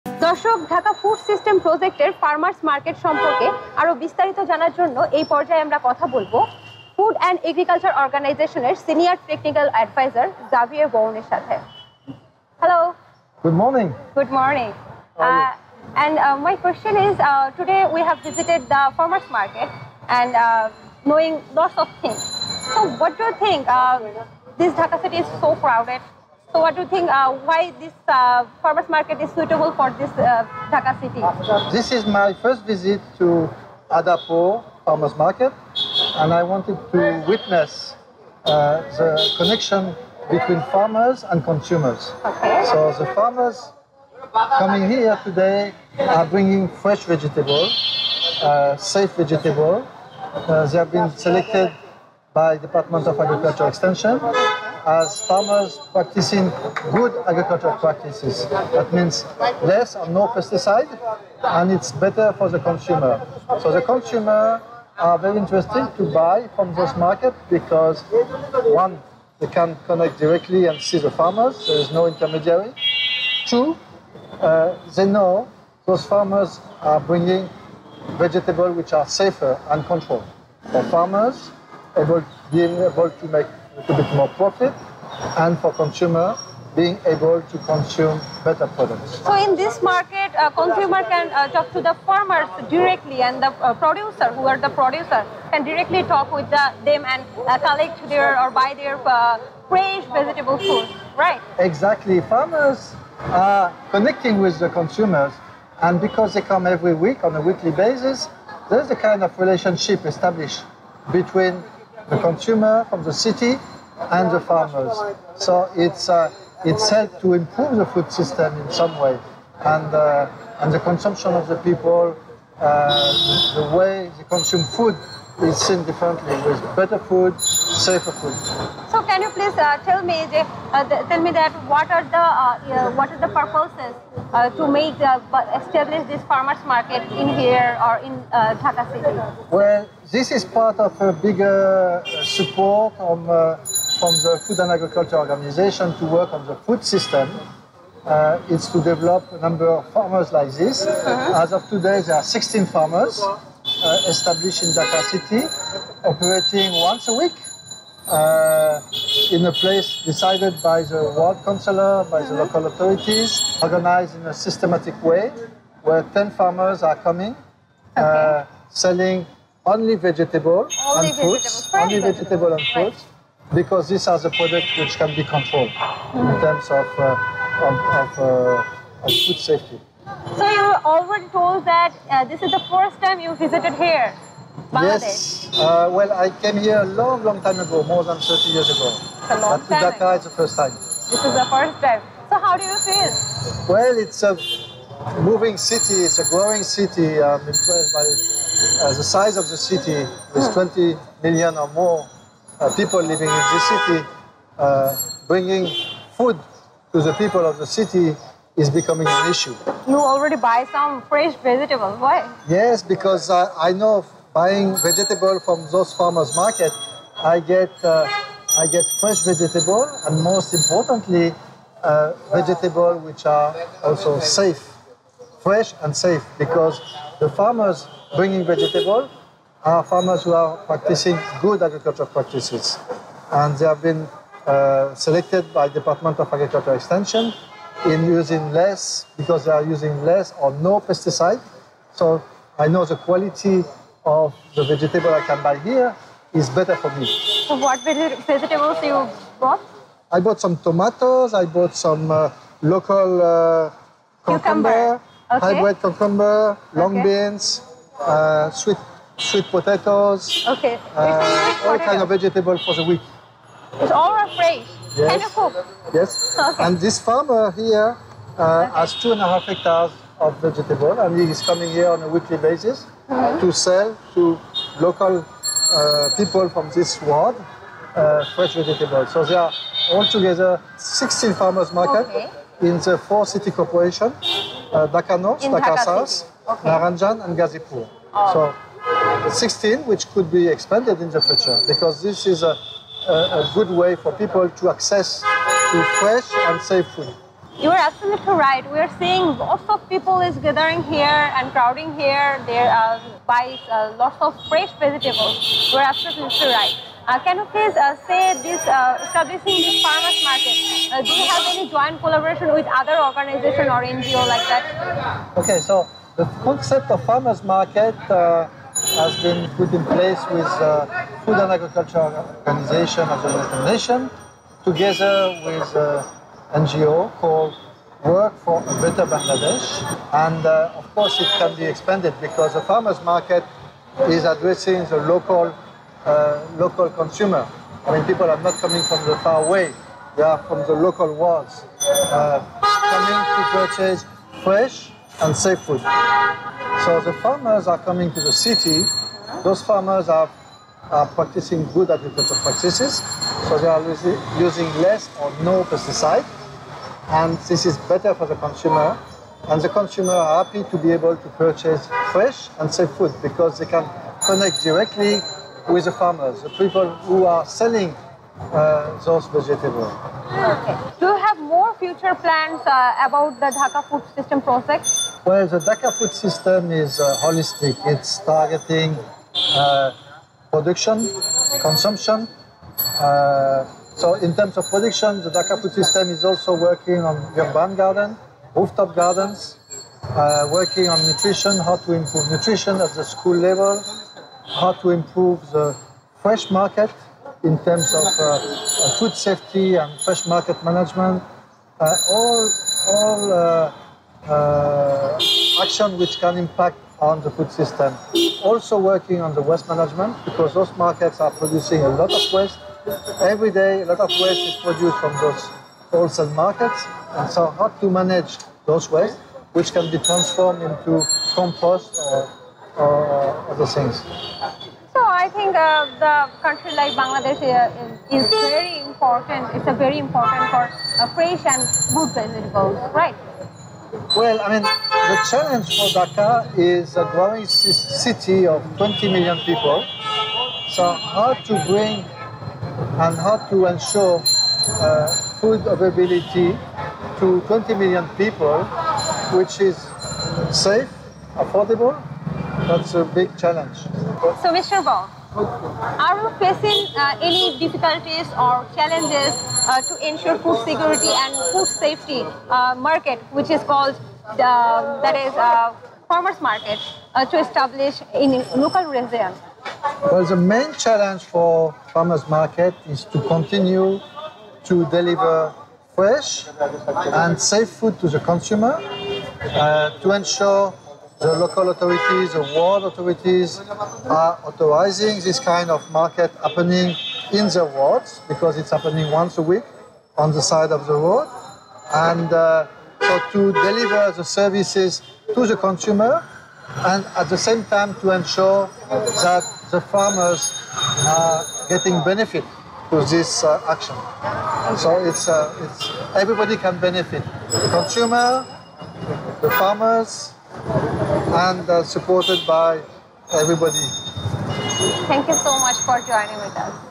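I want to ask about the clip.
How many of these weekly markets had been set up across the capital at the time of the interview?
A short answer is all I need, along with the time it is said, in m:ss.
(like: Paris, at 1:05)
16, at 2:32.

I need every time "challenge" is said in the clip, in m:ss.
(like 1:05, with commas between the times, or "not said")
7:15, 7:33, 7:38, 7:50.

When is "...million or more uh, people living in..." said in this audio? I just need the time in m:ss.
3:21.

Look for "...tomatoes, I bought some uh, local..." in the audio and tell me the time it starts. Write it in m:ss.
4:10.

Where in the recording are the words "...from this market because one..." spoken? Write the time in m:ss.
1:06.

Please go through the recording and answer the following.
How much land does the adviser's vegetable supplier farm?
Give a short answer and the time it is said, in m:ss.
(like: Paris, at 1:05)
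2.5 hectares, at 4:28.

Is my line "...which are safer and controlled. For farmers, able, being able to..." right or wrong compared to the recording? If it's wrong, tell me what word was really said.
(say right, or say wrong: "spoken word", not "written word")
right.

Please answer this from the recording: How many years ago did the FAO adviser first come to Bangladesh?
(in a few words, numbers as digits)
more than 30 years.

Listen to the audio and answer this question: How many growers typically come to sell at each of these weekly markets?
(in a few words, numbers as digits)
10.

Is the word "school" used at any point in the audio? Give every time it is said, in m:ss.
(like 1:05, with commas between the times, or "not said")
6:33.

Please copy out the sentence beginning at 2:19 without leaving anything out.
Well, this is part of a bigger support on, from the Food and Agriculture Organization to work on the food system.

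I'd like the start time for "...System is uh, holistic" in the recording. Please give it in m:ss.
6:16.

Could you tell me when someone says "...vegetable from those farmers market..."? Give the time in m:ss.
3:34.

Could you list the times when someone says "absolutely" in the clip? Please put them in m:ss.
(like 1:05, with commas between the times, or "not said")
4:57, 5:05.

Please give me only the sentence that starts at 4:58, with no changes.
We are seeing lots of people is gathering here and crowding here.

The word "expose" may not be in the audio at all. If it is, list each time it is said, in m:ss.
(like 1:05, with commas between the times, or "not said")
not said.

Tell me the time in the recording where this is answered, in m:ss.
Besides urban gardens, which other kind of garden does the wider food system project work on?
6:28.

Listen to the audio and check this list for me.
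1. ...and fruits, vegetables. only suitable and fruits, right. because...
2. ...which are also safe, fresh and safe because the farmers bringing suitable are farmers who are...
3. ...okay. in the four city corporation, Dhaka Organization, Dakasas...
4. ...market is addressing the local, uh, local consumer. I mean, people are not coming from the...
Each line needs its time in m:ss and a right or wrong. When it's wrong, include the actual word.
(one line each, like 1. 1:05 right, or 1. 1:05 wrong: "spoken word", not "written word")
1. 2:51 wrong: "vegetable", not "suitable"
2. 3:42 wrong: "vegetable", not "suitable"
3. 4:42 wrong: "North", not "Organization"
4. 5:33 right.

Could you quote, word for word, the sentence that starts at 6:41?
Uh, all all uh, uh, action which can impact on the food system.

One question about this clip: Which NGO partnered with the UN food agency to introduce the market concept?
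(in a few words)
Work for a Better Bangladesh.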